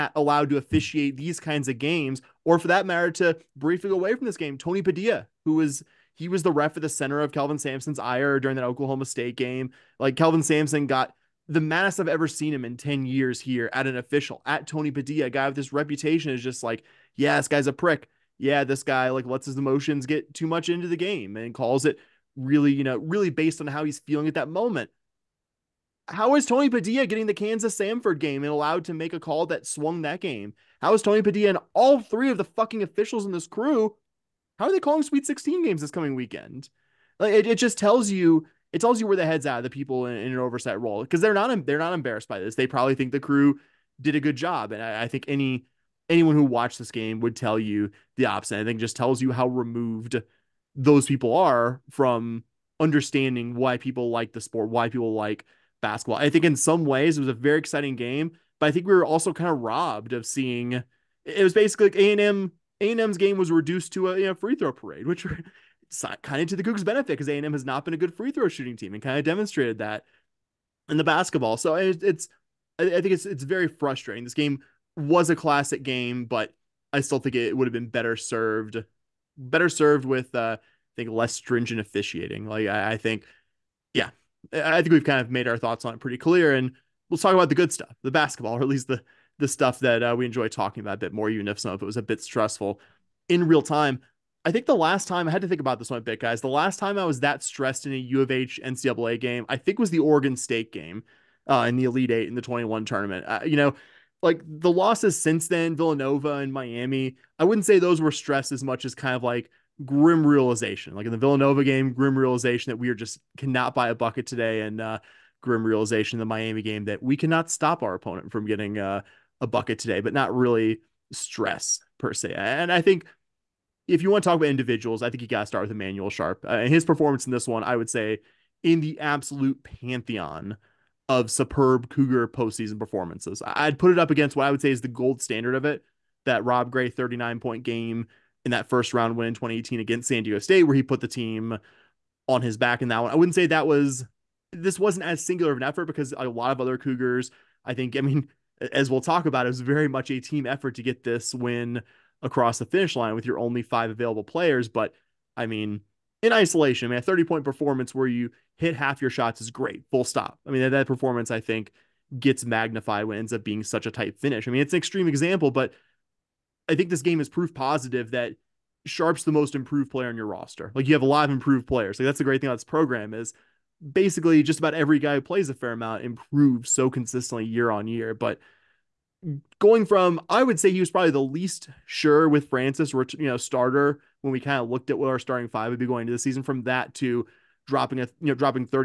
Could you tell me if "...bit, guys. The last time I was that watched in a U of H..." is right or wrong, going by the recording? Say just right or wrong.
wrong.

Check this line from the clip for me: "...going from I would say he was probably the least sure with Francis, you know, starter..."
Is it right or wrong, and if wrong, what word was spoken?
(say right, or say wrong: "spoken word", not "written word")
right.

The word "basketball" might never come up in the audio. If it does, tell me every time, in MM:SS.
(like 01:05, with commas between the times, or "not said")
00:55, 01:11, 01:28.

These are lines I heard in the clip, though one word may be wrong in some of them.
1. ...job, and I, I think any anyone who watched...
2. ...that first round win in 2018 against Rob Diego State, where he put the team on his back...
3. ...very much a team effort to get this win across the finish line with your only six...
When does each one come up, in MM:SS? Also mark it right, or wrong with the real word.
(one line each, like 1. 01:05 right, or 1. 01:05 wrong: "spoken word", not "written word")
1. 00:44 right
2. 02:18 wrong: "San", not "Rob"
3. 02:29 wrong: "five", not "six".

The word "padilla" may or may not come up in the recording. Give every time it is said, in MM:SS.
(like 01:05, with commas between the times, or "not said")
00:04, 00:14, 00:26, 00:31.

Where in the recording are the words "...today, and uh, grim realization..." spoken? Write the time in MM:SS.
01:54.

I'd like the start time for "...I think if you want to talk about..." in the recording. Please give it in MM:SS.
02:02.